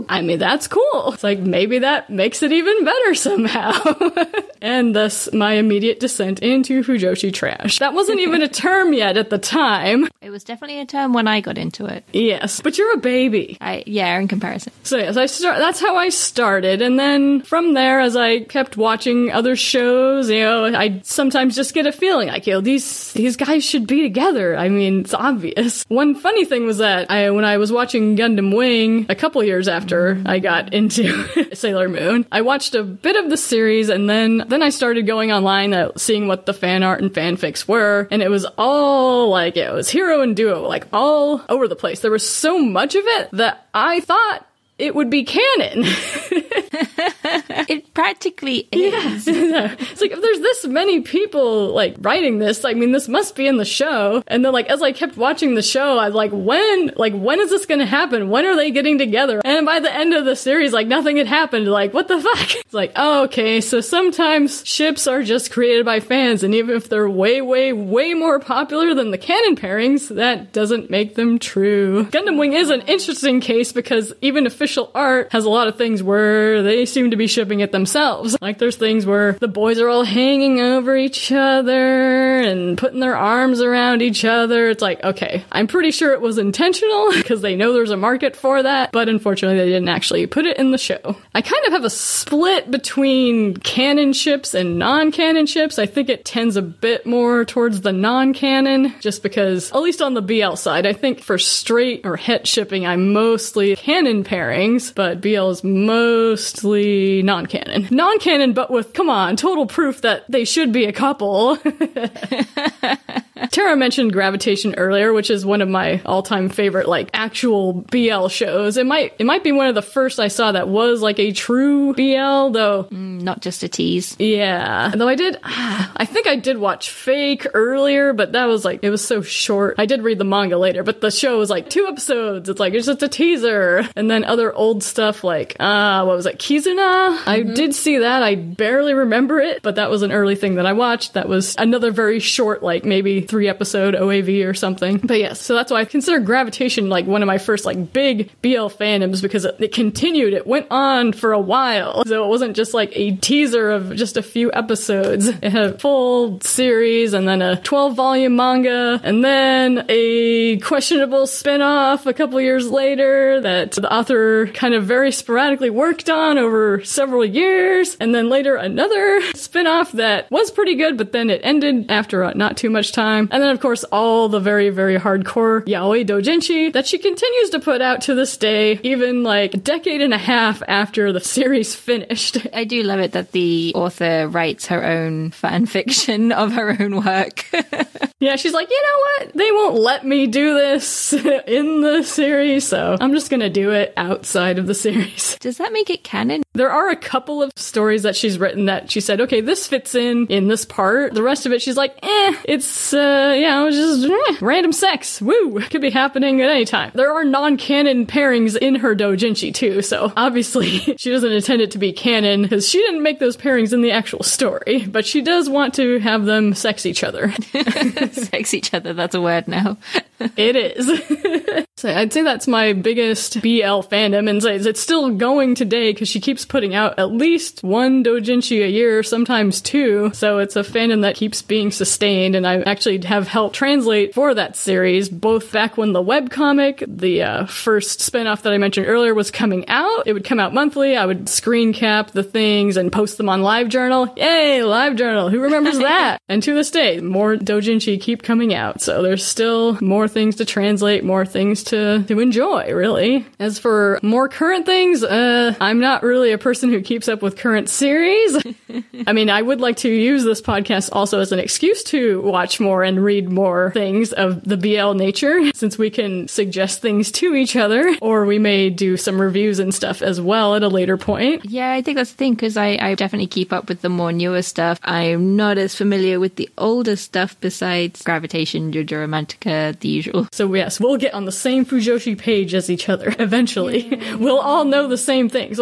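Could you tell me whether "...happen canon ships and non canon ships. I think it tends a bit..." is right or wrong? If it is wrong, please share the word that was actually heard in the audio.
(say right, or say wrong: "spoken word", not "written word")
wrong: "between", not "happen".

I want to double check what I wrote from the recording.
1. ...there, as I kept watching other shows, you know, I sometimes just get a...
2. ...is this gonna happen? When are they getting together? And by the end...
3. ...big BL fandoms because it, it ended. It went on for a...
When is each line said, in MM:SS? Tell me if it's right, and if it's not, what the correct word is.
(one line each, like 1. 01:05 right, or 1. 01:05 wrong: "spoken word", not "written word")
1. 00:17 right
2. 00:57 right
3. 02:27 wrong: "continued", not "ended".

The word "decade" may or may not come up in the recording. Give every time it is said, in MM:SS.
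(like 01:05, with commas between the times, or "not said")
02:59.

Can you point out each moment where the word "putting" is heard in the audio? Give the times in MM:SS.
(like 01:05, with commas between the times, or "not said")
01:22, 03:46.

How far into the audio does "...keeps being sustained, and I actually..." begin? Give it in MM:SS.
03:51.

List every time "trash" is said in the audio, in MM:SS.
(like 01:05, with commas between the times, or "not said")
00:07.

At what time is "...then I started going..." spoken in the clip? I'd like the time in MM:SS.
00:34.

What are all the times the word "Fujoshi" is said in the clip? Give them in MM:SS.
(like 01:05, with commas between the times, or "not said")
00:06, 04:41.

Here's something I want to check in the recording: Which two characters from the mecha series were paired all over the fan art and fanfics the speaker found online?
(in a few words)
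Heero and Duo.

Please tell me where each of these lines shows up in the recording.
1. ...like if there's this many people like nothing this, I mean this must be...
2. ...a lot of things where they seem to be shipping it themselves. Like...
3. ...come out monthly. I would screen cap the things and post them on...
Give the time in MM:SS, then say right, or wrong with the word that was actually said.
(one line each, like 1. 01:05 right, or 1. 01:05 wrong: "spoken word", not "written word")
1. 00:50 wrong: "writing", not "nothing"
2. 01:15 right
3. 04:00 right.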